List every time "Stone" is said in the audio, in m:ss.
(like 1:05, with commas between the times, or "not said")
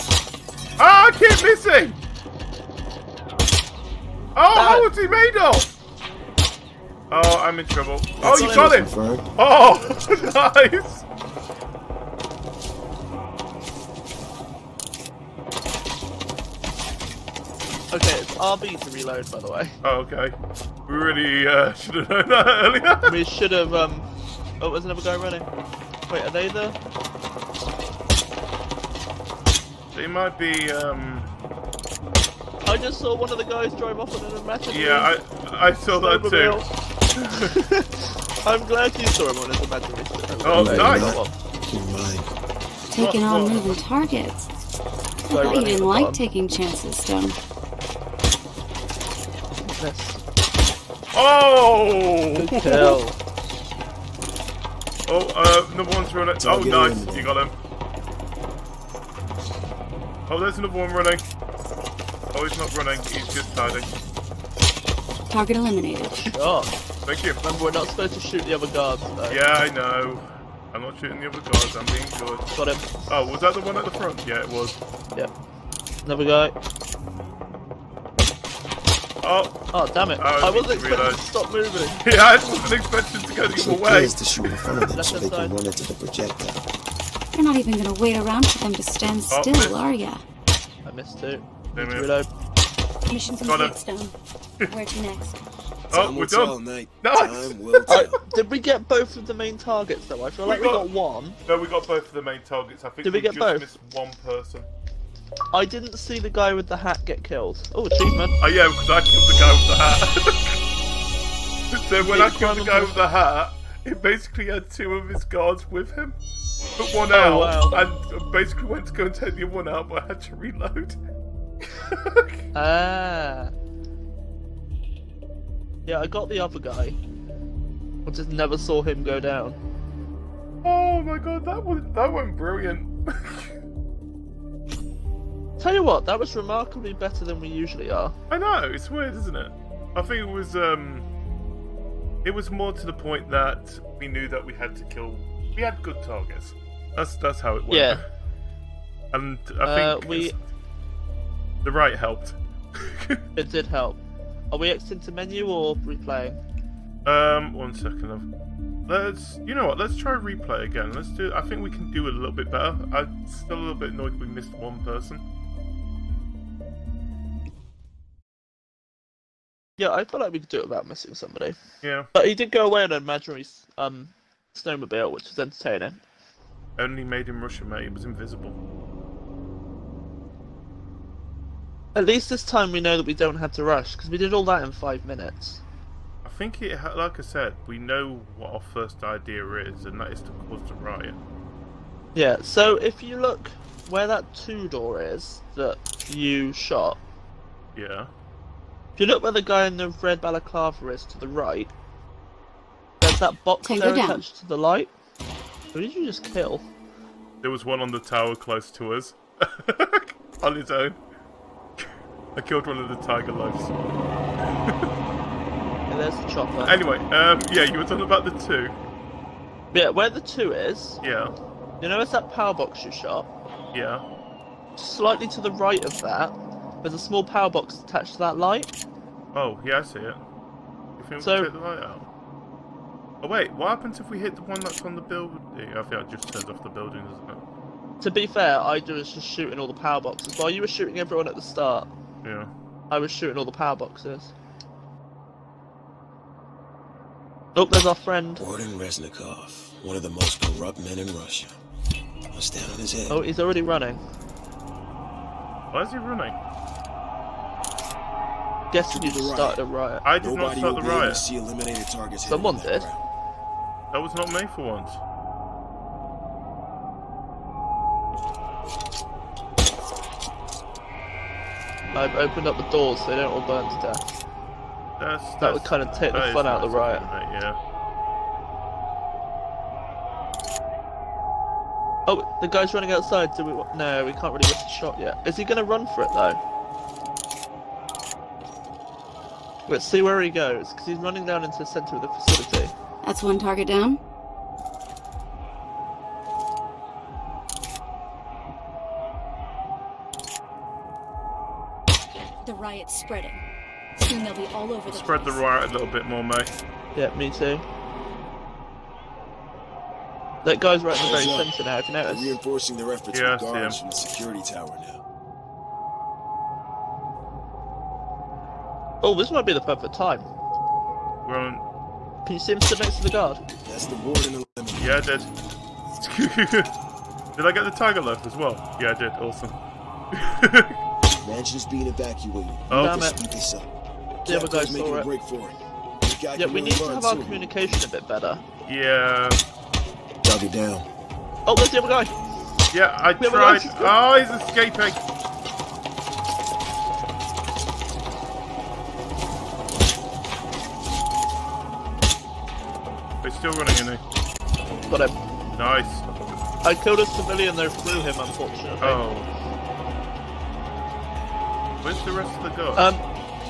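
0:46, 1:33.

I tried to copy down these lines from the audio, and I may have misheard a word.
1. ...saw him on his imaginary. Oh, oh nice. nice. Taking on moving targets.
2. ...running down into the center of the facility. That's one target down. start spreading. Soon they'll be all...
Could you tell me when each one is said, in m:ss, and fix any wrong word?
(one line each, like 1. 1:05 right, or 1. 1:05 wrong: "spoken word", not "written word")
1. 0:39 right
2. 4:50 right.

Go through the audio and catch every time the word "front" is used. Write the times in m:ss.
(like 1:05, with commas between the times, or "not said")
1:13, 1:24.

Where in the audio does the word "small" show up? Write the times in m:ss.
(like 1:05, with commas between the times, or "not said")
3:46.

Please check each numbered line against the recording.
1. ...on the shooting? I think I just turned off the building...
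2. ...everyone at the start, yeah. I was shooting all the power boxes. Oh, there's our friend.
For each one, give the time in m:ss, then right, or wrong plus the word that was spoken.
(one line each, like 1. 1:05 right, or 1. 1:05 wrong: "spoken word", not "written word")
1. 3:54 wrong: "building", not "shooting"
2. 4:01 right.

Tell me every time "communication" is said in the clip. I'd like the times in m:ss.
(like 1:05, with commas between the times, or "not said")
5:37.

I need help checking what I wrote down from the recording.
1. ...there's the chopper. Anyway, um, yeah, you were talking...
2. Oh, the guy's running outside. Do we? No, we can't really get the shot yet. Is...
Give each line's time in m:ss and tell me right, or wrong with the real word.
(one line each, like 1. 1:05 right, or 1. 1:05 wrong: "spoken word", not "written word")
1. 3:35 right
2. 4:42 right.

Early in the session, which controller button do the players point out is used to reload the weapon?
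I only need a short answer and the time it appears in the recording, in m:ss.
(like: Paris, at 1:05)
RB, at 0:18.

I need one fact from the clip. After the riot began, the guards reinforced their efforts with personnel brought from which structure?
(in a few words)
Security tower.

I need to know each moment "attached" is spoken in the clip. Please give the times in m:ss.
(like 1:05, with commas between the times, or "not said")
3:23, 3:47.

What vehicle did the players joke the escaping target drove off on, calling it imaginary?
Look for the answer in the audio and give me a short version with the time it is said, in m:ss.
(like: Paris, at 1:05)
Snowmobile, at 2:54.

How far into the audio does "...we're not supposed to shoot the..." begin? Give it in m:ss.
1:07.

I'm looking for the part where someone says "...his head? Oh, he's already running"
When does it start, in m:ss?
4:12.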